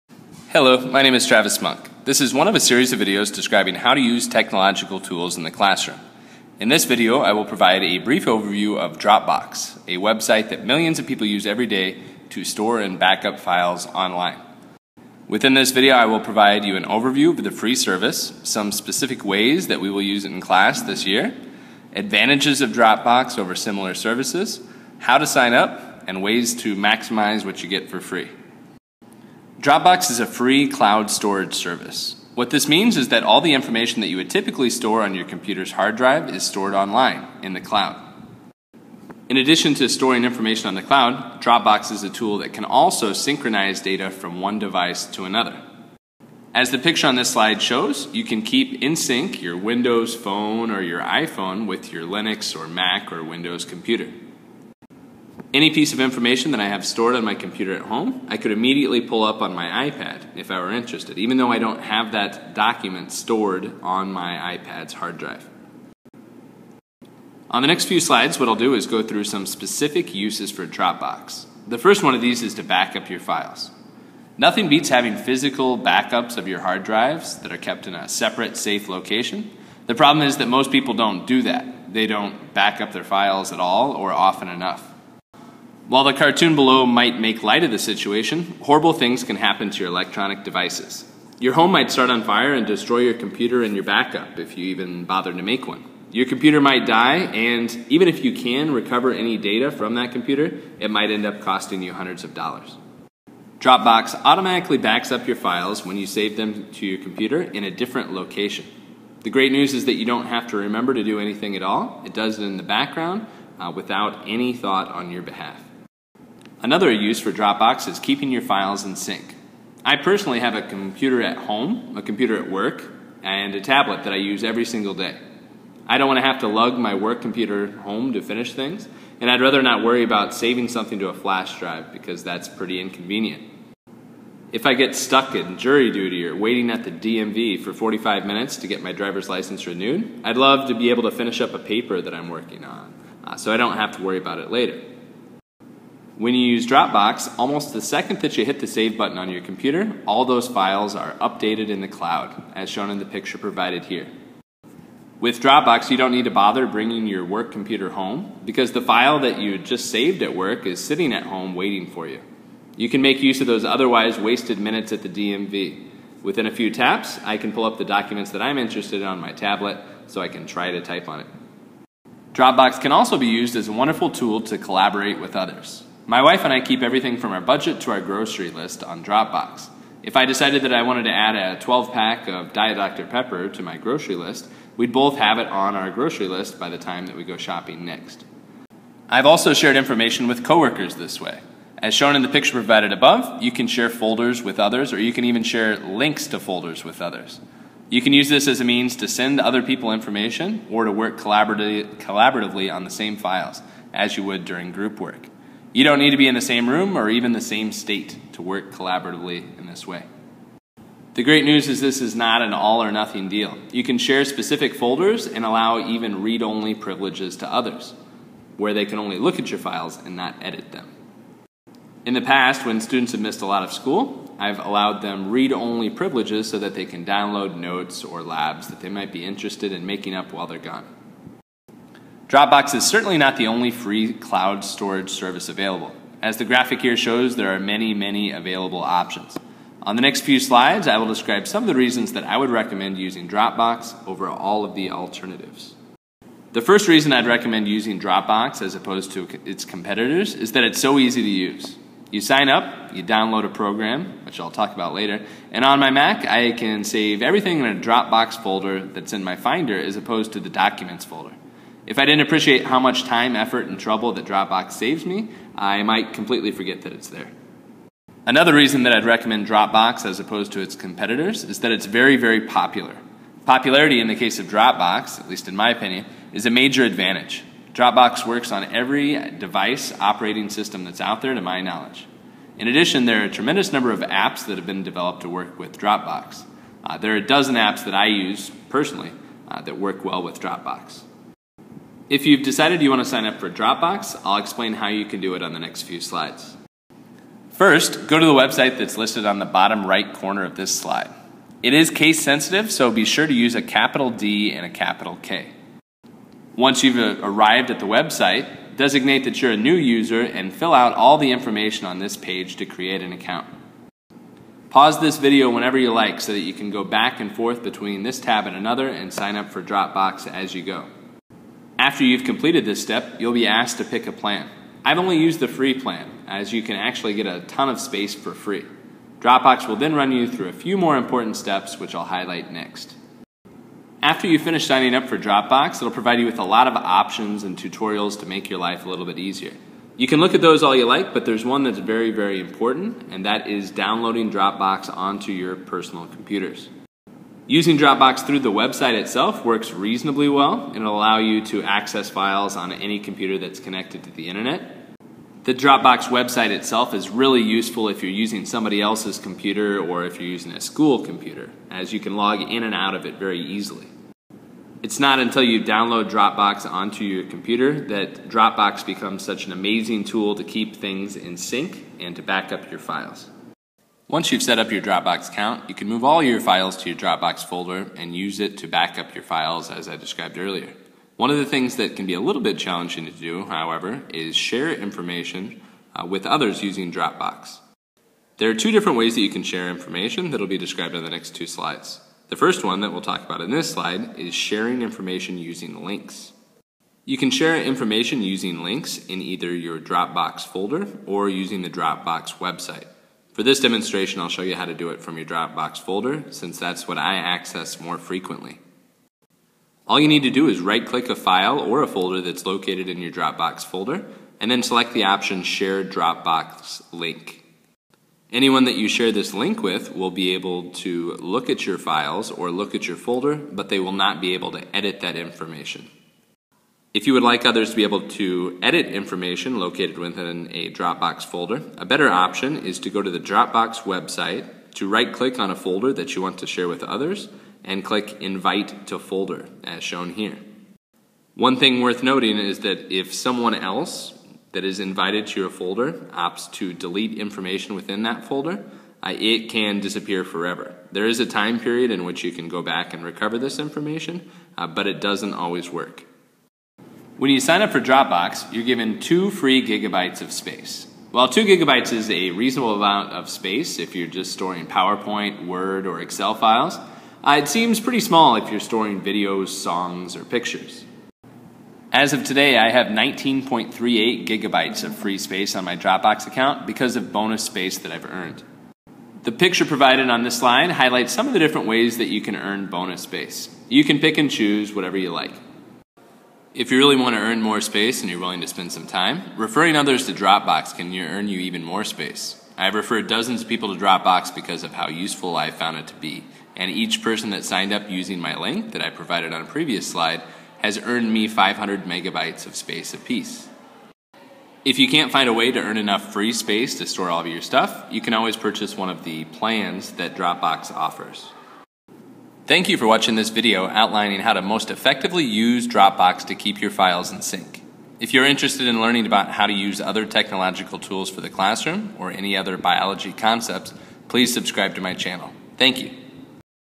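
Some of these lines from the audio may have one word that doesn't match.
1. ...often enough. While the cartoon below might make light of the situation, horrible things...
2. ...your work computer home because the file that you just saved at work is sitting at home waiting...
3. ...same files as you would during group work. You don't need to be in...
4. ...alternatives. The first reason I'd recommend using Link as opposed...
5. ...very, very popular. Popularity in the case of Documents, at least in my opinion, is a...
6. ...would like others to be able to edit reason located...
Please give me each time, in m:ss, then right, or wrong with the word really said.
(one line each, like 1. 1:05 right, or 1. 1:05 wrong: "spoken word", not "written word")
1. 1:24 right
2. 2:37 right
3. 3:22 right
4. 4:04 wrong: "Dropbox", not "Link"
5. 4:31 wrong: "Dropbox", not "Documents"
6. 7:07 wrong: "information", not "reason".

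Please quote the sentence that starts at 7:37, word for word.
When you sign up for Dropbox, you're given two free gigabytes of space.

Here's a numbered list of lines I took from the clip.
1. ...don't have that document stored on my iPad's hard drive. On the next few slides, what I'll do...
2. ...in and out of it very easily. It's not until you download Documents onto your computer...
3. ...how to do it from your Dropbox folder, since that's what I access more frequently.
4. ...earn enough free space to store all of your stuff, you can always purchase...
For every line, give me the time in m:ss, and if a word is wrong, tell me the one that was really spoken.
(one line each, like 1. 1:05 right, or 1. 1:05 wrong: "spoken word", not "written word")
1. 1:01 right
2. 6:02 wrong: "Dropbox", not "Documents"
3. 6:44 right
4. 8:25 right.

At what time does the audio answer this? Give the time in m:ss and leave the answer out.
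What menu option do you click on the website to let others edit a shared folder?
7:18.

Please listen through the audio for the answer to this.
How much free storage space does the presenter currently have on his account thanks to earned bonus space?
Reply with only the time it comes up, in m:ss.
7:52.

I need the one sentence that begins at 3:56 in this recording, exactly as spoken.
As the graphic here shows, there are many, many available options.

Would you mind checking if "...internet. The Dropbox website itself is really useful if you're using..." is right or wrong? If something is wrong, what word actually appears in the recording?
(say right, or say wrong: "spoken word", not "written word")
right.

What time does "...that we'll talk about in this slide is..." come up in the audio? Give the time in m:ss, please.
6:32.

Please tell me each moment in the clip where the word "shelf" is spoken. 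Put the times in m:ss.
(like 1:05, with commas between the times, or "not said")
not said.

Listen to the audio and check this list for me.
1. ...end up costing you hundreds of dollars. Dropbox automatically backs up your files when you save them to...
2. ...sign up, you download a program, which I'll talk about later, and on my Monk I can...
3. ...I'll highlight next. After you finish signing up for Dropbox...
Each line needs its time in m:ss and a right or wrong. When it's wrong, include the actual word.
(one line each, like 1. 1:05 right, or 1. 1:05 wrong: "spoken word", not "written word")
1. 1:41 right
2. 4:12 wrong: "Mac", not "Monk"
3. 5:31 right.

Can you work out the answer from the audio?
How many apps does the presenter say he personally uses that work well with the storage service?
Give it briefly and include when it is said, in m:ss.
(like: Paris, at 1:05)
12, at 4:47.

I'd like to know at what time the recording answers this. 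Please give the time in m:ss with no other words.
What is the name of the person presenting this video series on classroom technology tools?
0:01.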